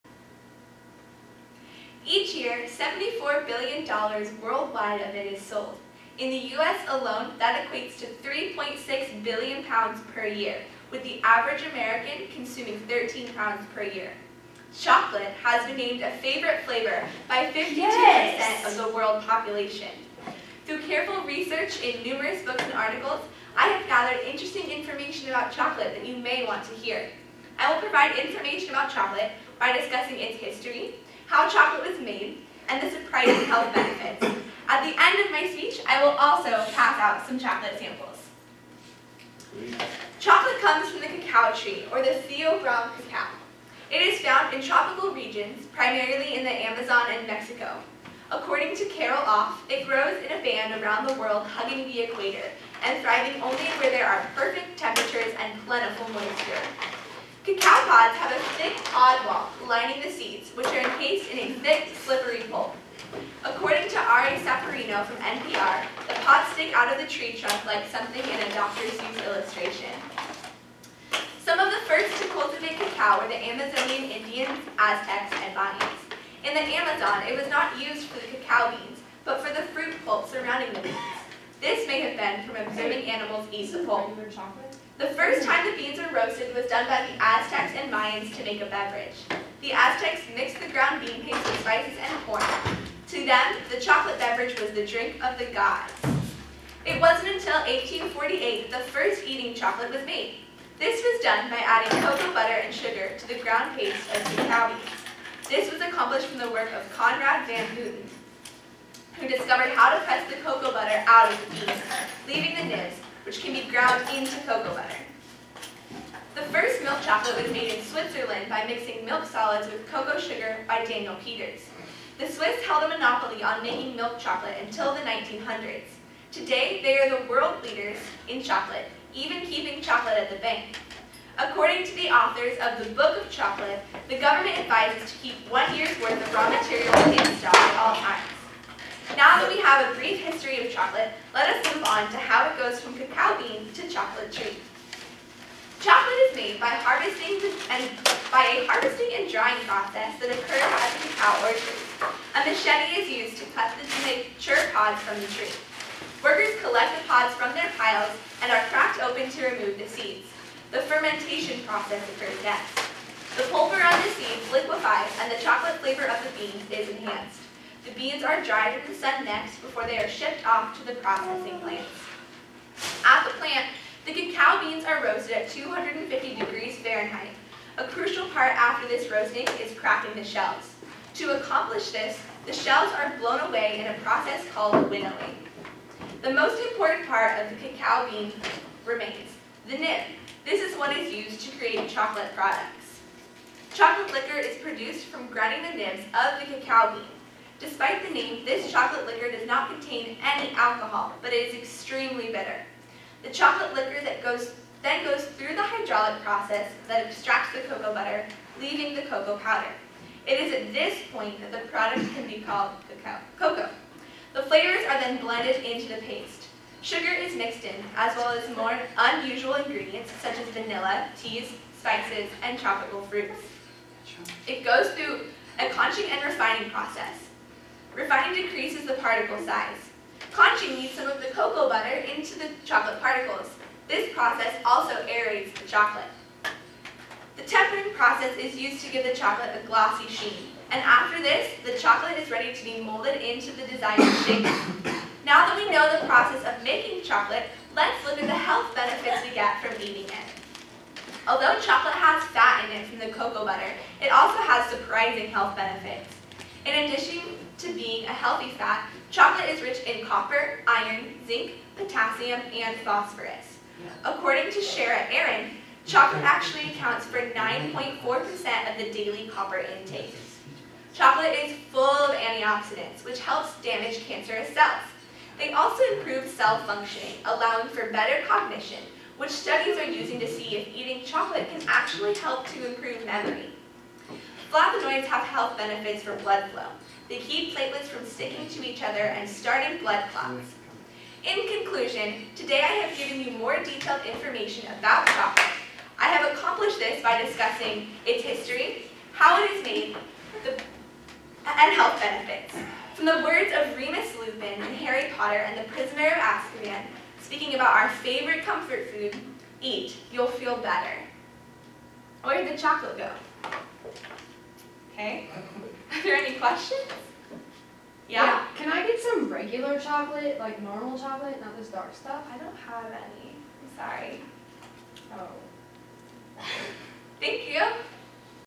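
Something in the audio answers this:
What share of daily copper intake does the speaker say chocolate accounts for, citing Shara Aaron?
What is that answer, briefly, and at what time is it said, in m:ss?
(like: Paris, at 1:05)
9.4%, at 4:27.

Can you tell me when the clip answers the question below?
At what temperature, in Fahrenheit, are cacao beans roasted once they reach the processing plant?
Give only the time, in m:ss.
2:55.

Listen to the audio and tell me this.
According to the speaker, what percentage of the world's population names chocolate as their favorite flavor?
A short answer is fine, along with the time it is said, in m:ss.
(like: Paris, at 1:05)
52%, at 0:17.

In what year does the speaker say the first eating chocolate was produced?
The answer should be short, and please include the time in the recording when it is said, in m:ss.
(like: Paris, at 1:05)
1848, at 1:37.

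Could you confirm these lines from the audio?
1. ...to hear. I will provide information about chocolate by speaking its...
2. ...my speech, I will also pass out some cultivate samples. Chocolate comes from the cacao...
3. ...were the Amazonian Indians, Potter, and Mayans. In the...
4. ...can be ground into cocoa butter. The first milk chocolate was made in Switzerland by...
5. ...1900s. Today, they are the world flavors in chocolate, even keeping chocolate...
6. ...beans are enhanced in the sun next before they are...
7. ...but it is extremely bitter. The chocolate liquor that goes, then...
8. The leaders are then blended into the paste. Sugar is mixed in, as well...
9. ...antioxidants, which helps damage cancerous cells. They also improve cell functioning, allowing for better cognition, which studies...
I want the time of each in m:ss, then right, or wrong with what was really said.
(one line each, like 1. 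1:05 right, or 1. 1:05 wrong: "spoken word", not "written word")
1. 0:26 wrong: "discussing", not "speaking"
2. 0:35 wrong: "chocolate", not "cultivate"
3. 1:13 wrong: "Aztecs", not "Potter"
4. 1:53 right
5. 2:05 wrong: "leaders", not "flavors"
6. 2:47 wrong: "dried", not "enhanced"
7. 3:21 right
8. 3:34 wrong: "flavors", not "leaders"
9. 4:32 right.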